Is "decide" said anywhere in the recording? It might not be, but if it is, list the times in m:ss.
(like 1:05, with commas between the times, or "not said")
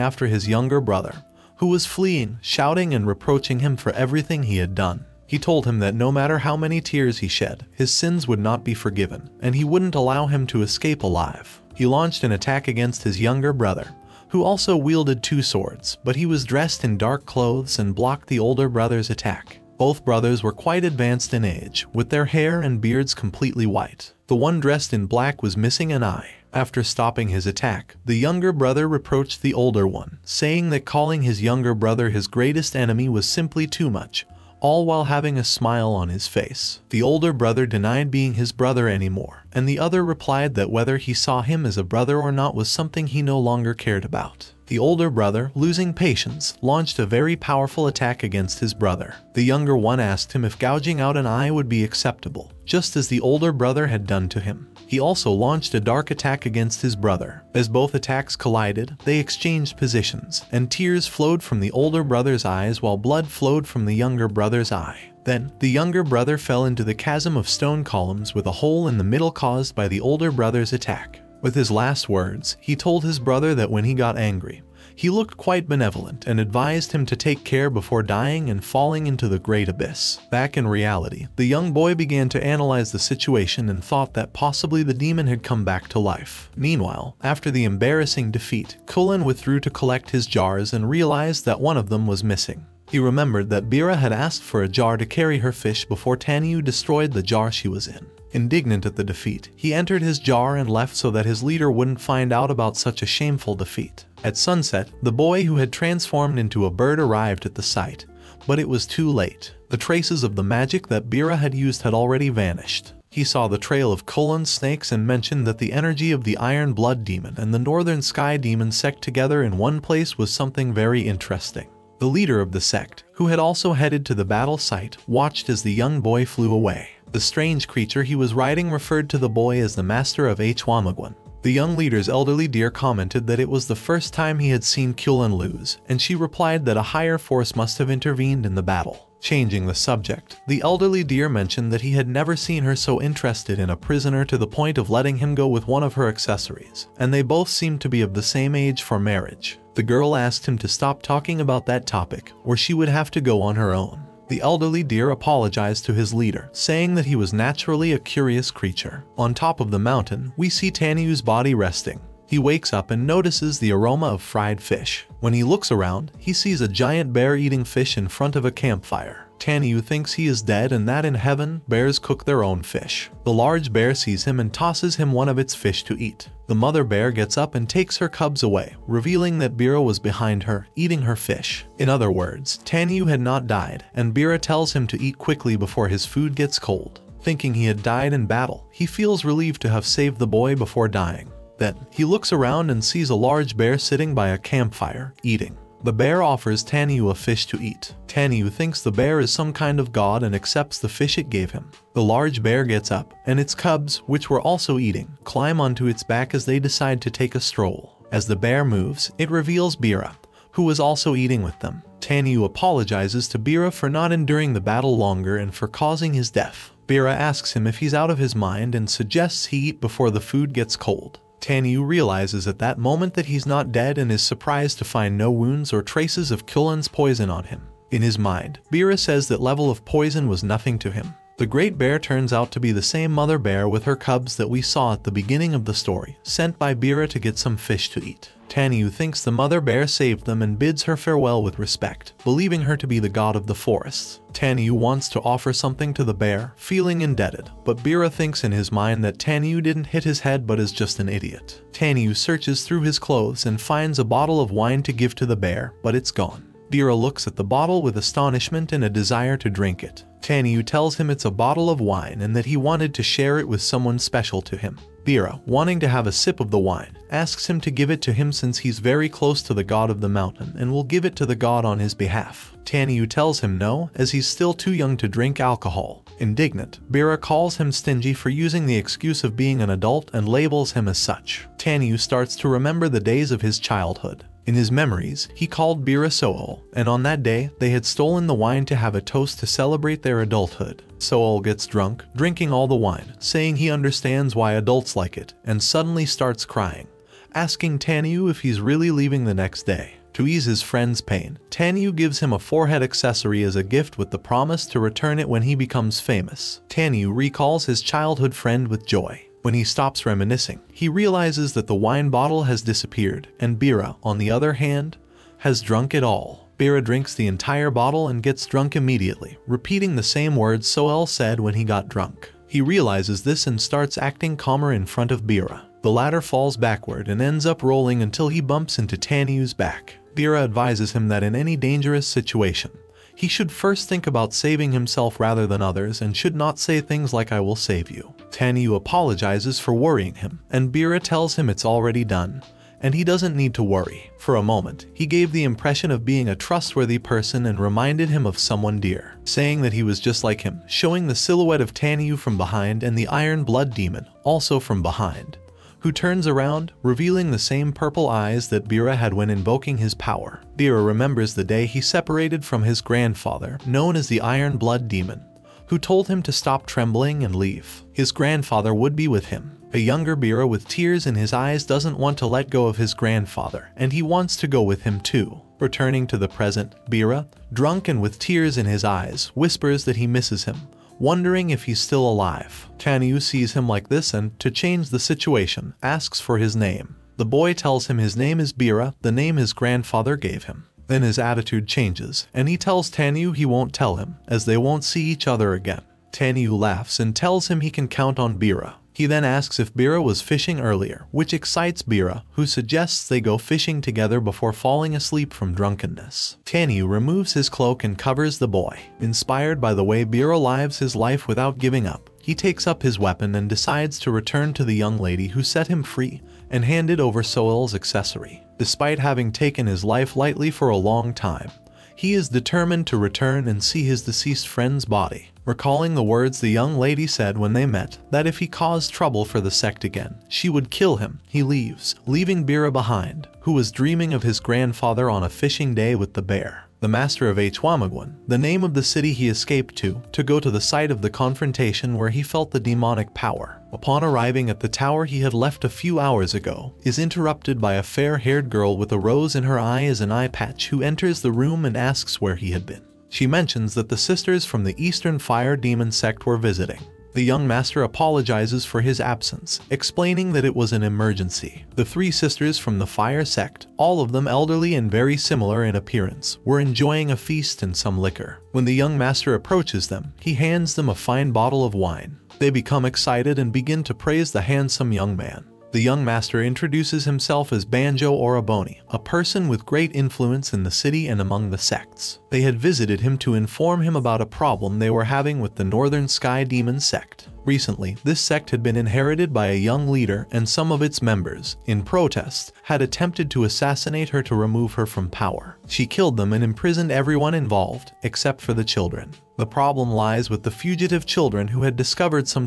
3:26, 6:53.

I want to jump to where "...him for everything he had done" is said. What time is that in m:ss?
0:03.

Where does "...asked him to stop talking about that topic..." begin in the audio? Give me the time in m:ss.
2:30.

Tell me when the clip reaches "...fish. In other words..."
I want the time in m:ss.
3:01.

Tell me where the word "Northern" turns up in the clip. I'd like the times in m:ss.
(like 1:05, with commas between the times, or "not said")
1:57, 8:05.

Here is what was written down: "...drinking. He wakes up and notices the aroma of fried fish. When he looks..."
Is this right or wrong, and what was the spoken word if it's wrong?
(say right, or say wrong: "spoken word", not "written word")
wrong: "resting", not "drinking".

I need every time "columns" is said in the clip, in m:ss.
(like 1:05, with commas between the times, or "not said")
1:07.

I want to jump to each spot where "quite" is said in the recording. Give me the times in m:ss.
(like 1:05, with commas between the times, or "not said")
0:20, 1:15.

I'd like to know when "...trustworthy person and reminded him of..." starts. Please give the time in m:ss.
5:46.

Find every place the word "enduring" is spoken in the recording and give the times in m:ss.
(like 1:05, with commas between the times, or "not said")
3:34.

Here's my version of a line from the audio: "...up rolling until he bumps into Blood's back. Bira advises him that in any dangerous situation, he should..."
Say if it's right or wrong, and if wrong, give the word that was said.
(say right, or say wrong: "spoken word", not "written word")
wrong: "Tanyu", not "Blood".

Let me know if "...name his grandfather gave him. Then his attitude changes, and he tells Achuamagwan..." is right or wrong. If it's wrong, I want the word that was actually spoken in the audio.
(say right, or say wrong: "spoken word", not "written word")
wrong: "Tanyu", not "Achuamagwan".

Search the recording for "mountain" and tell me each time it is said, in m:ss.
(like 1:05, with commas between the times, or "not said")
2:39, 4:30.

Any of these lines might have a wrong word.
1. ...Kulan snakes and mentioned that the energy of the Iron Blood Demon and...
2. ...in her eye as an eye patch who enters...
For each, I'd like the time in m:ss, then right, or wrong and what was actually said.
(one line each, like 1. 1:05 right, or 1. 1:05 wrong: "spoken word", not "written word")
1. 1:54 right
2. 7:29 right.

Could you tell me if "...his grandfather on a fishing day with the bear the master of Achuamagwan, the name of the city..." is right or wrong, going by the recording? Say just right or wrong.
right.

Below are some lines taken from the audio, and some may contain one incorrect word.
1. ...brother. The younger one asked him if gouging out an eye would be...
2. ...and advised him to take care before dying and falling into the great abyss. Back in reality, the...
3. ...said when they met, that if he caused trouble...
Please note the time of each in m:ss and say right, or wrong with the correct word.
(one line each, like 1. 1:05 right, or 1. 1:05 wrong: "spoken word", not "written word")
1. 0:48 right
2. 1:16 right
3. 7:07 right.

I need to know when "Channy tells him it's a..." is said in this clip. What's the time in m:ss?
4:20.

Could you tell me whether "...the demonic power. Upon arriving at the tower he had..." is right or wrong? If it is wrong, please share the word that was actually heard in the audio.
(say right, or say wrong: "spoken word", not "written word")
right.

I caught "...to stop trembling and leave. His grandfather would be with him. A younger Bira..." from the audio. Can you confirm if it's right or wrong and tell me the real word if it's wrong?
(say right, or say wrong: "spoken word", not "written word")
right.